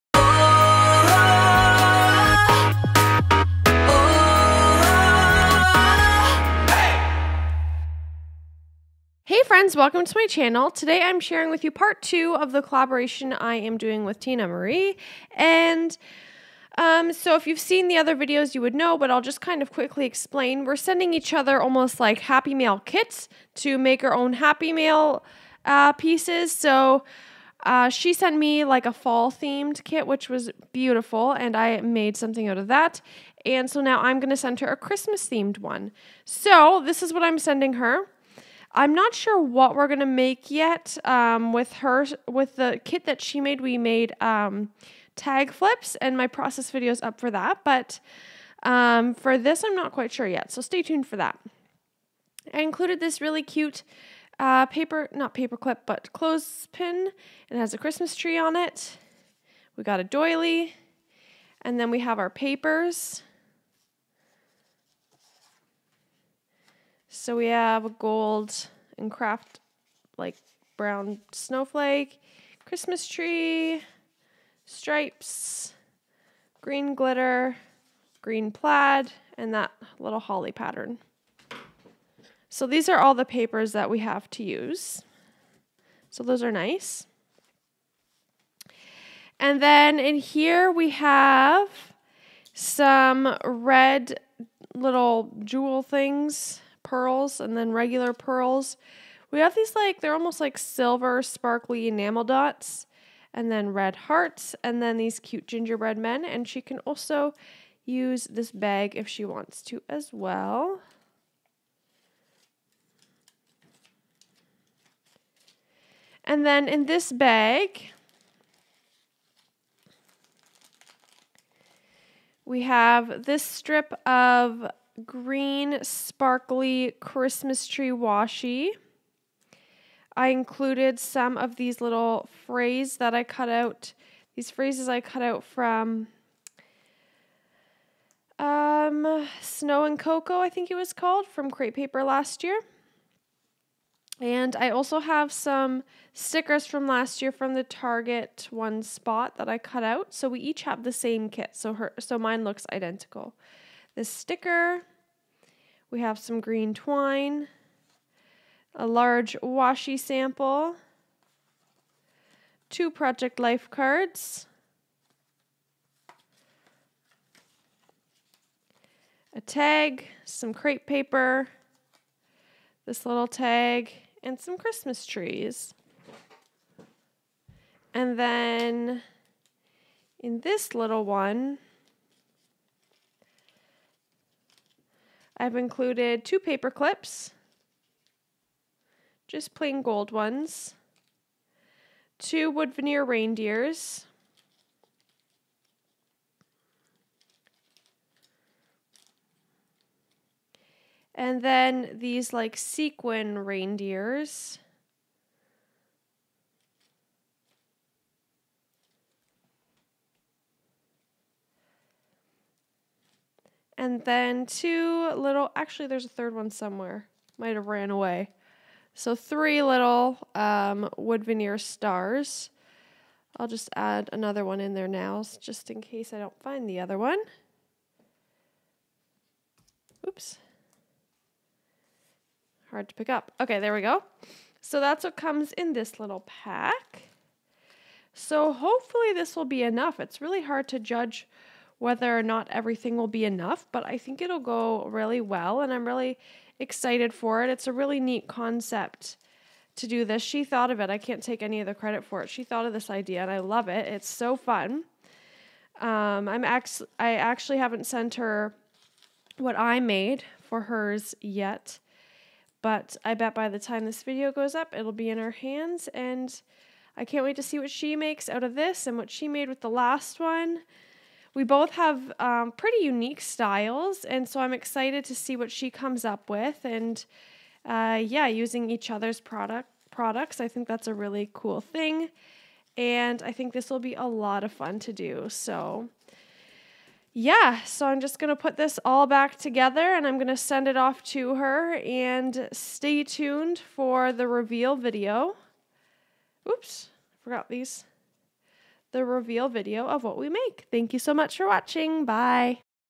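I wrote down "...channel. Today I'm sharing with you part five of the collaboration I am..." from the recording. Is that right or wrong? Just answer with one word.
wrong.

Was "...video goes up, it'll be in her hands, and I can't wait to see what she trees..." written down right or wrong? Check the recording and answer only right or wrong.
wrong.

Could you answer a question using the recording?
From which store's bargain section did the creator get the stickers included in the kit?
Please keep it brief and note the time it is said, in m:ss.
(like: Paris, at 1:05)
Target, at 2:27.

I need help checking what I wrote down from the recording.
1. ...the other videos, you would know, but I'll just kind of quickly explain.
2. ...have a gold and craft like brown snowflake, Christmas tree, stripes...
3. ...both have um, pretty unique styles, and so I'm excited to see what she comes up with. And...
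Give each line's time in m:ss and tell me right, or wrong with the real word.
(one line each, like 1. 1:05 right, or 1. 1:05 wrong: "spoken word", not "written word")
1. 0:17 right
2. 1:07 right
3. 4:31 right.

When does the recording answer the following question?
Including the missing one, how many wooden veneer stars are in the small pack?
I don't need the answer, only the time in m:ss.
3:39.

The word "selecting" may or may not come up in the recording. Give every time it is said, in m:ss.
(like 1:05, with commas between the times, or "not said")
not said.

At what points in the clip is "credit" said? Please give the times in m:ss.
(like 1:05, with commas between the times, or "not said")
4:11.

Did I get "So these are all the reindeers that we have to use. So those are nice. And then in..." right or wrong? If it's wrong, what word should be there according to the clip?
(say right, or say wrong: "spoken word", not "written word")
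wrong: "papers", not "reindeers".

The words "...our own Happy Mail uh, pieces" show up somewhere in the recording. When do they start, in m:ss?
0:24.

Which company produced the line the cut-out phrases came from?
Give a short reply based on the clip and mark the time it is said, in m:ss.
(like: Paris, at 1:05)
Crate Paper, at 2:21.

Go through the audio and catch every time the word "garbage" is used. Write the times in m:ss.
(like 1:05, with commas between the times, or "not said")
not said.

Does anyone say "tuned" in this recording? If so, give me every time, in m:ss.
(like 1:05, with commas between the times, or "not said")
0:50, 4:53.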